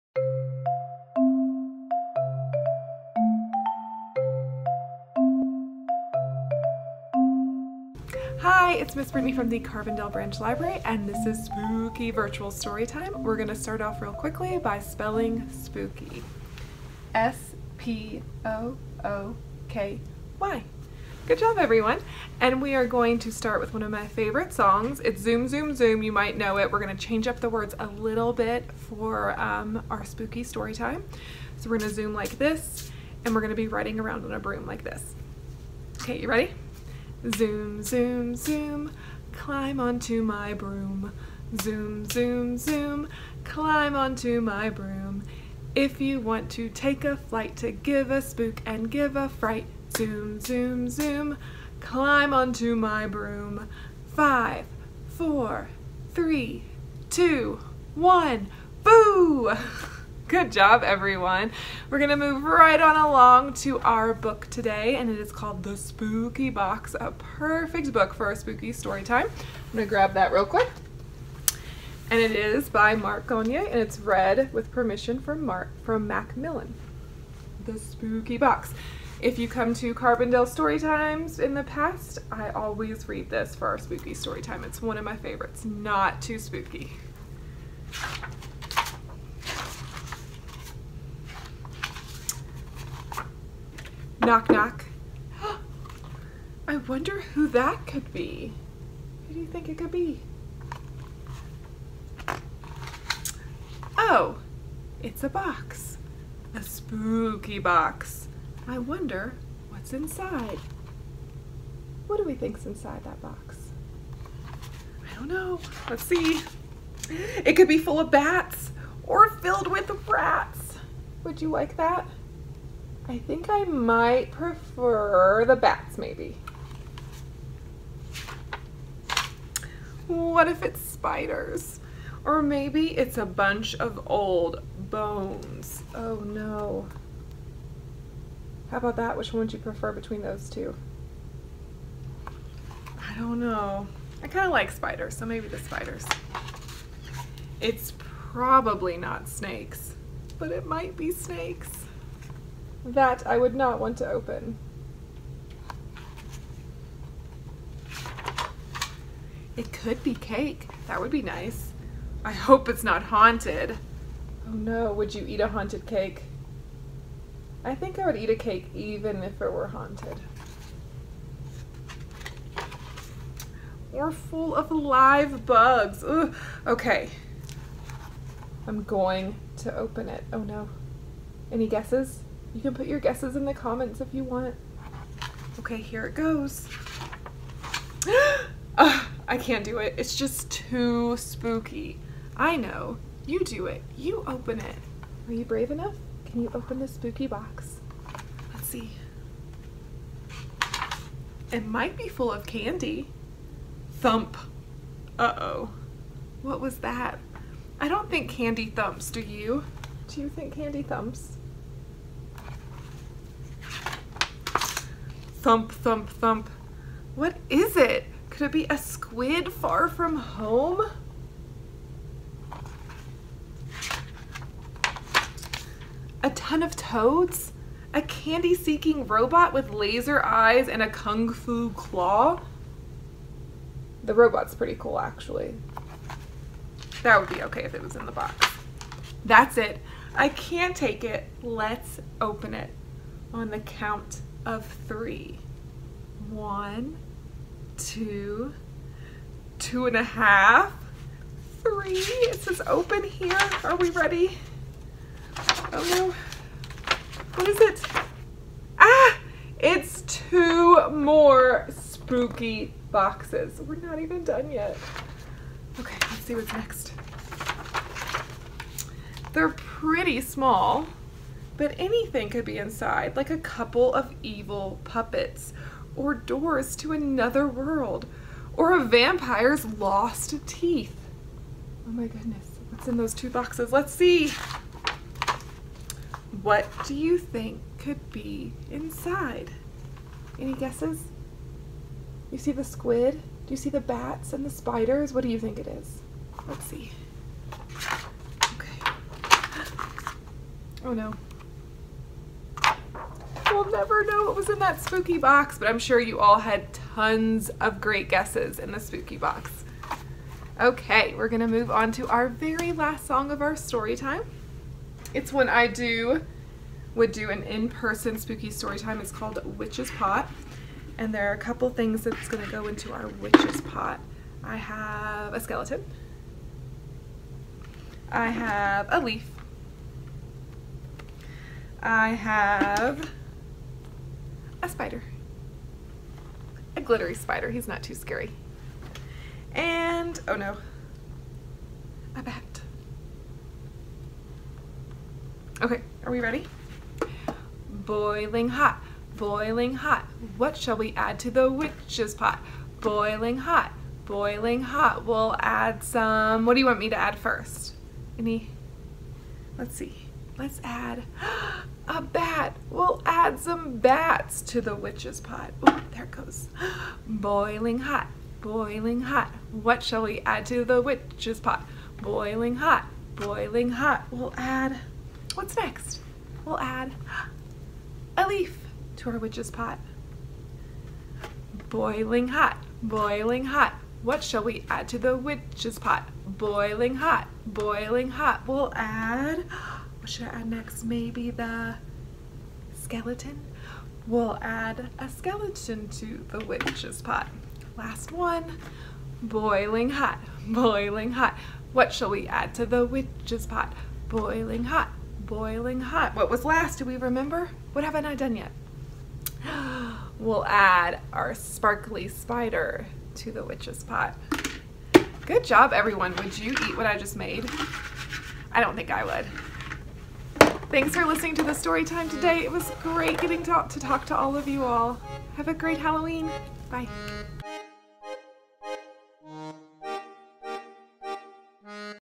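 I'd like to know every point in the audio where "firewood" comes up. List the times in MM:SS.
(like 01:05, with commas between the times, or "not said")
not said.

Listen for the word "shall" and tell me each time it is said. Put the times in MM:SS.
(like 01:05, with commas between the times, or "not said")
05:50, 06:09, 06:24, 06:41.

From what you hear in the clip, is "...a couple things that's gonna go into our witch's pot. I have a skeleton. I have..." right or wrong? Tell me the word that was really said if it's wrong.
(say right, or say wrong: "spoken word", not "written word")
right.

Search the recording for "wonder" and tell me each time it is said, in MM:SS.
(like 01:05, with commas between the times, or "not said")
01:36, 01:48.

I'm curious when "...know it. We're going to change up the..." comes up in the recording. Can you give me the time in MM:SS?
00:26.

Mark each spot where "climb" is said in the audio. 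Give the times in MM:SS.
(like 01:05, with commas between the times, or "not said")
00:39, 00:43, 00:51.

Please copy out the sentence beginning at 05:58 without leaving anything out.
Any, let's see, let's add a bat.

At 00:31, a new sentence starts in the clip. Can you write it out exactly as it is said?
So we're going to zoom like this and we're going to be riding around on a broom like this.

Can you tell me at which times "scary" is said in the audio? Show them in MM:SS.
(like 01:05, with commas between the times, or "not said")
05:37.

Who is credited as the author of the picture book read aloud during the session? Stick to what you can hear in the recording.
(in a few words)
Mark Gonyea.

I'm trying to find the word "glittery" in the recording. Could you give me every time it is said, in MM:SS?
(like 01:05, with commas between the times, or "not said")
05:36.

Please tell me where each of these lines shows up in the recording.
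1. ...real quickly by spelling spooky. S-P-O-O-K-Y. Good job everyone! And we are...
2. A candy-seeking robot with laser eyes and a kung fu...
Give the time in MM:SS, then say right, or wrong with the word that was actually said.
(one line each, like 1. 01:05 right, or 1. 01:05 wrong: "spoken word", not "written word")
1. 00:14 right
2. 03:47 right.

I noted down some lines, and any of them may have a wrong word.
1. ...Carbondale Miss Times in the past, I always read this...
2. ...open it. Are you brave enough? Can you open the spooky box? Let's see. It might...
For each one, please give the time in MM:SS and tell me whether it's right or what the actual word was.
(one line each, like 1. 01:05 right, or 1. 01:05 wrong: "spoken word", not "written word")
1. 01:19 wrong: "Story", not "Miss"
2. 03:14 right.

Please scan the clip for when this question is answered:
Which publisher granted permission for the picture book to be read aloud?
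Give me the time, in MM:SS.
01:16.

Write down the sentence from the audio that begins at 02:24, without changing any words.
I kind of like spiders, so maybe the spiders.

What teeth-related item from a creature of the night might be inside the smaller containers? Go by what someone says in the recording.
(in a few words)
a vampire's lost teeth.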